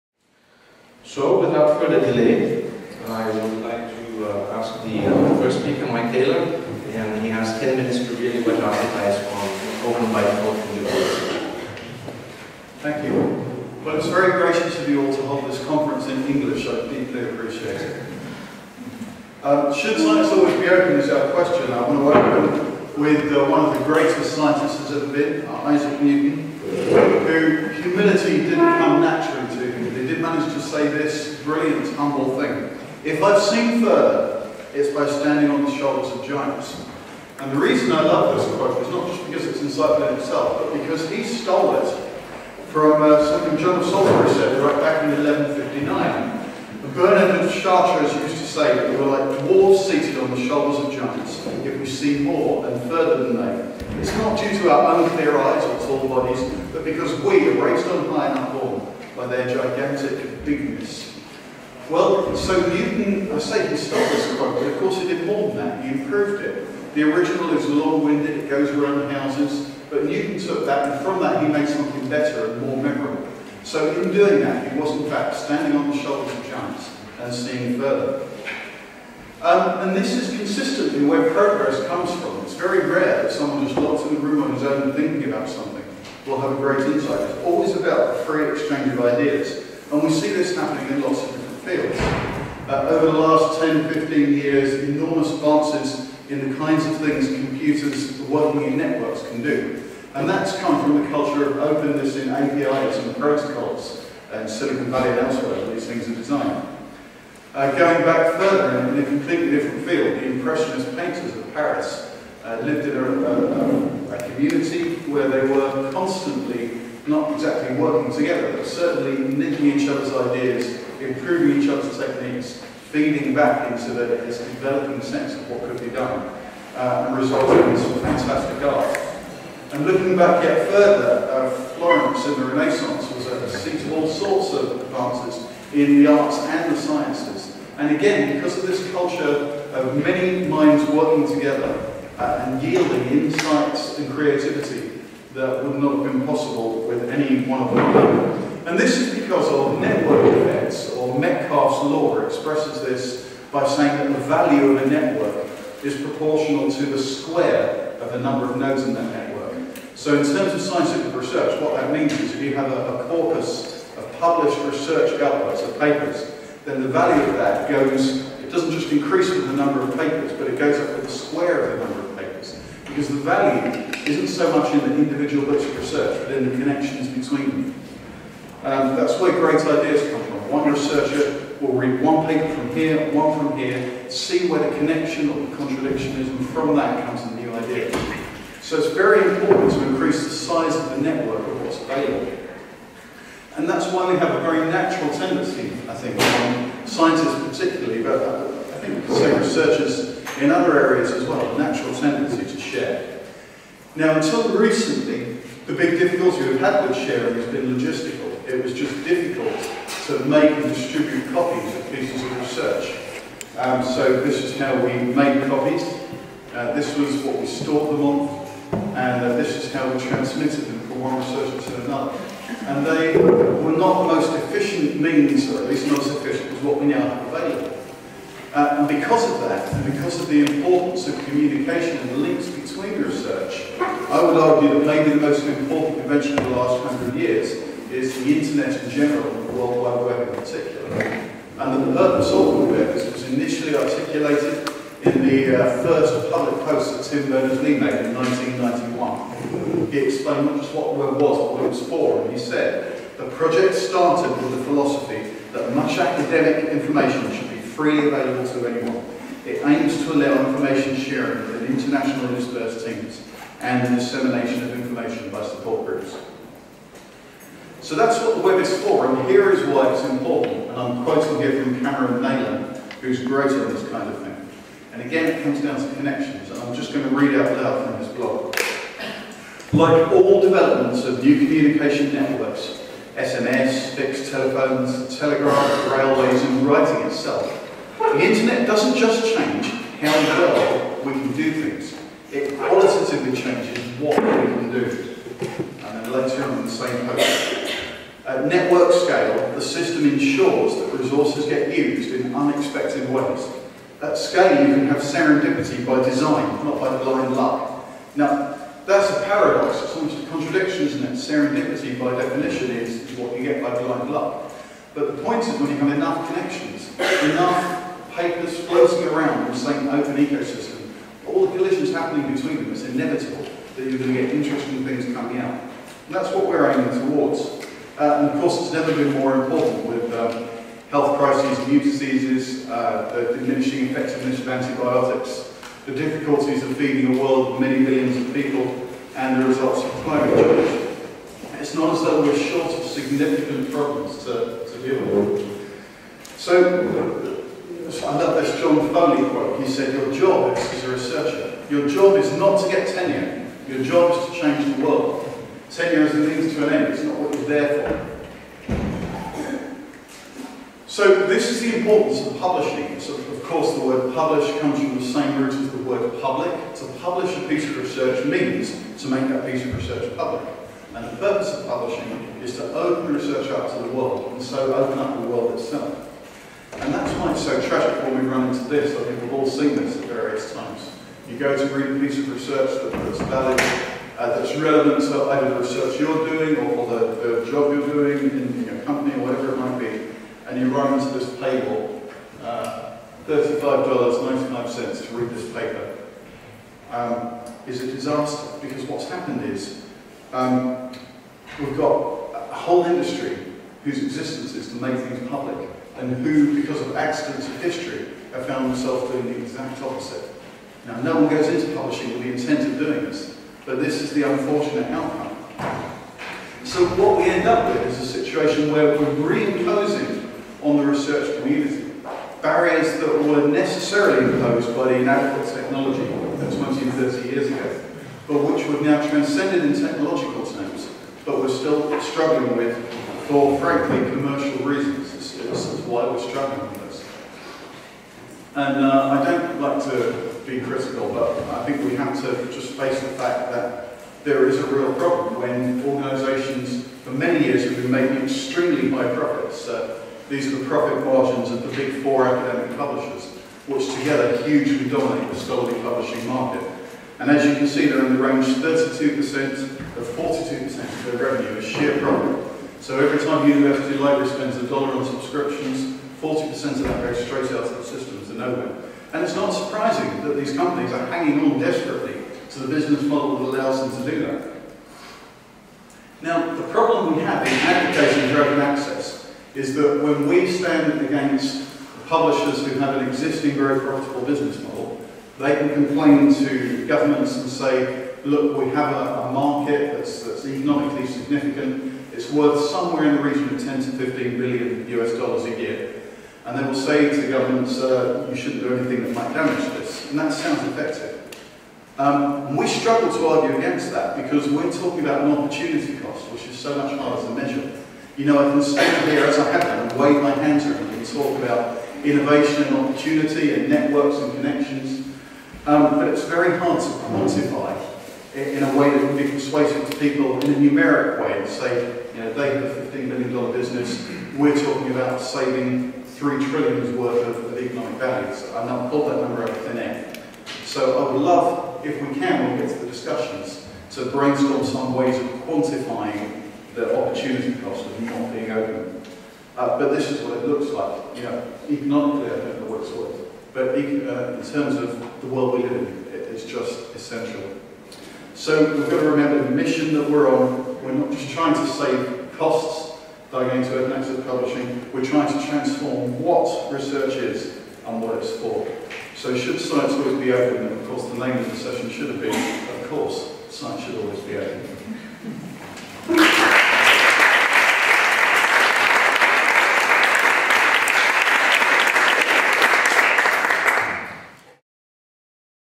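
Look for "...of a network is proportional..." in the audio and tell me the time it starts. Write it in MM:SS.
02:34.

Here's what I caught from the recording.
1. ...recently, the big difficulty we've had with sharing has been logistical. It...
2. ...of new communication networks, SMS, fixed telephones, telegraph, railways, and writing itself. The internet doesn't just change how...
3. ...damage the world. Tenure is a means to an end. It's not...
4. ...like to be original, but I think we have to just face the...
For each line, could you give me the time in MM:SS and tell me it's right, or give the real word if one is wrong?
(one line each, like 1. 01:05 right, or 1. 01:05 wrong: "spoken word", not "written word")
1. 03:24 right
2. 04:41 right
3. 05:54 wrong: "change", not "damage"
4. 07:19 wrong: "critical", not "original".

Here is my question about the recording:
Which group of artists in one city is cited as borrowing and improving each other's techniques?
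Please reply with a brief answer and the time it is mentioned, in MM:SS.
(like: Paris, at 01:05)
Impressionist painters, at 01:50.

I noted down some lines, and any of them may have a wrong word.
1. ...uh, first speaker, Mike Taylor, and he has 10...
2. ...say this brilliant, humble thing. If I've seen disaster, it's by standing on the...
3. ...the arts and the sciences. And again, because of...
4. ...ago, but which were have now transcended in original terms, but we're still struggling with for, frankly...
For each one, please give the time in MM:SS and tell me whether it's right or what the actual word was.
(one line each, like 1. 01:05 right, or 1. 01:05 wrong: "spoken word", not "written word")
1. 00:05 right
2. 00:30 wrong: "further", not "disaster"
3. 02:16 right
4. 07:07 wrong: "technological", not "original".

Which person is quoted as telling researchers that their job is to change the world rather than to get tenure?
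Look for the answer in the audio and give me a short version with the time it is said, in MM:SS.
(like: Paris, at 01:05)
John Foley, at 05:48.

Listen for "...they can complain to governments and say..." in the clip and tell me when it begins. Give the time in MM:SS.
08:05.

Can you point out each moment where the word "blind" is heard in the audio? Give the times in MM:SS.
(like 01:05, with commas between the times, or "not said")
05:07, 05:13.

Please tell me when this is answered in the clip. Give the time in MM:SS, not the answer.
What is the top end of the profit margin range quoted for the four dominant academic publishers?
07:40.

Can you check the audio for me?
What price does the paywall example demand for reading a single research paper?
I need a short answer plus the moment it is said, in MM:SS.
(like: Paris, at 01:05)
$35.95, at 06:33.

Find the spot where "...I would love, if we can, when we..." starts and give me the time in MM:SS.
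08:51.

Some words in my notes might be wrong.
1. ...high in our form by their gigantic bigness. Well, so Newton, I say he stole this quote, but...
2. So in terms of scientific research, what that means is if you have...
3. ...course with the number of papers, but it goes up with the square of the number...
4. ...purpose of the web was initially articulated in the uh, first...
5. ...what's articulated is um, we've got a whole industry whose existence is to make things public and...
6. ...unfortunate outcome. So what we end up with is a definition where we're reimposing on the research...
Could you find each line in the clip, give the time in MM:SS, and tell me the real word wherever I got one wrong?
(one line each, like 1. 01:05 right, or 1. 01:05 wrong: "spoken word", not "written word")
1. 00:58 right
2. 02:39 right
3. 02:48 wrong: "increase", not "course"
4. 04:01 right
5. 06:38 wrong: "happened", not "articulated"
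6. 06:54 wrong: "situation", not "definition".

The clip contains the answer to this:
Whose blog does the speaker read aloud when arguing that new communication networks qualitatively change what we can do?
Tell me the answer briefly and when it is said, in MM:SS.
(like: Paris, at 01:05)
Cameron Neylon, at 04:31.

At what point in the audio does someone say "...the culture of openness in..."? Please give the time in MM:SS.
01:41.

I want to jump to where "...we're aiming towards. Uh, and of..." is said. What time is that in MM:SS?
05:26.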